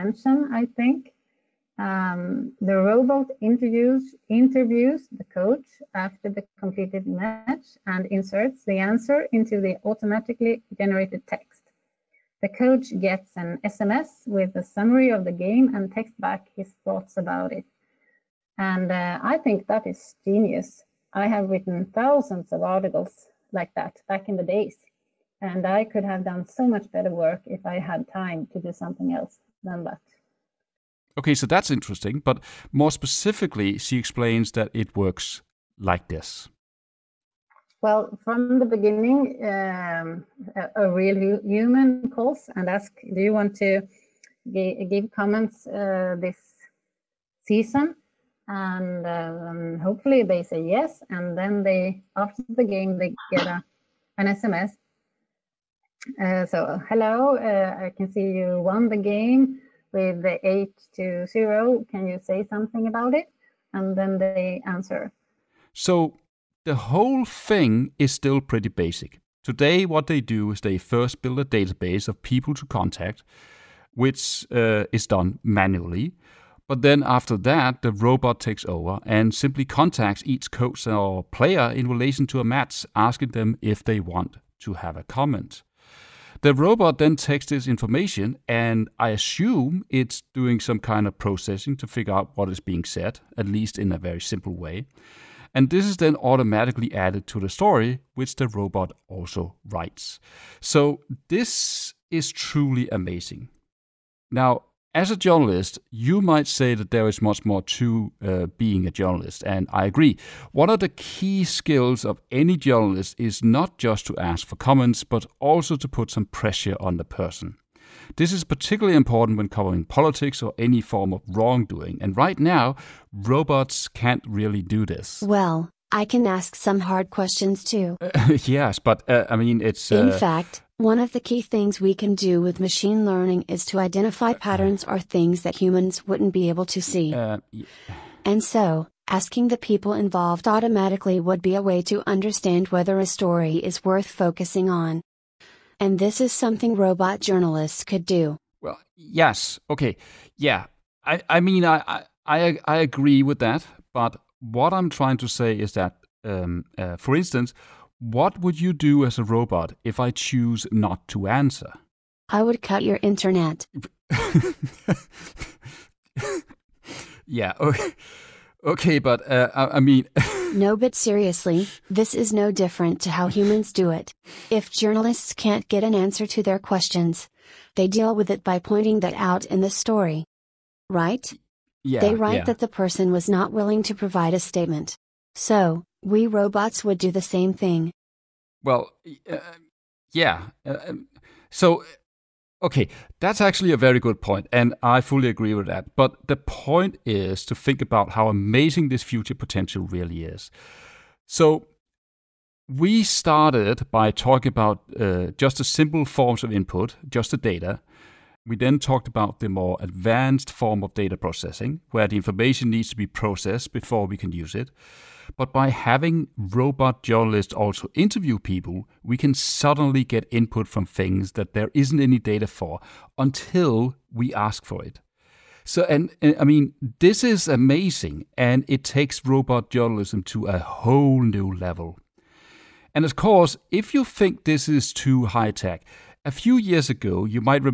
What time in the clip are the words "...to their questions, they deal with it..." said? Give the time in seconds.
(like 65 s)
176 s.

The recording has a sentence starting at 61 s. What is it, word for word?
Can you say something about it?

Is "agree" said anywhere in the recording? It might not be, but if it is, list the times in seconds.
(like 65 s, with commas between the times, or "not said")
109 s, 152 s, 195 s.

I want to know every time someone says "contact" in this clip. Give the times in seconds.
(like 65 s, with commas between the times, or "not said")
72 s, 79 s.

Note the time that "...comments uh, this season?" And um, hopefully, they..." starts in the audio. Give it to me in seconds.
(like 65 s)
45 s.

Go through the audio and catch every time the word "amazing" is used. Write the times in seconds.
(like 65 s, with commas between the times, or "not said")
102 s, 198 s, 227 s.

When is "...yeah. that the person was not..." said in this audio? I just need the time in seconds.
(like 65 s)
182 s.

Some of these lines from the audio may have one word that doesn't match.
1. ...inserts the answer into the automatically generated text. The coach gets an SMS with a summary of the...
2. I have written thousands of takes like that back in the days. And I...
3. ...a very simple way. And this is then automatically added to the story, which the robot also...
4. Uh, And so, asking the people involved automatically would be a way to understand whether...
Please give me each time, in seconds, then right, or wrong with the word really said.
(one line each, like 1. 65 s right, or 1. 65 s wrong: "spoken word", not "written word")
1. 8 s right
2. 21 s wrong: "articles", not "takes"
3. 93 s right
4. 137 s right.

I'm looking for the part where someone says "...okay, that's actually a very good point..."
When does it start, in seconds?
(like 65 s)
192 s.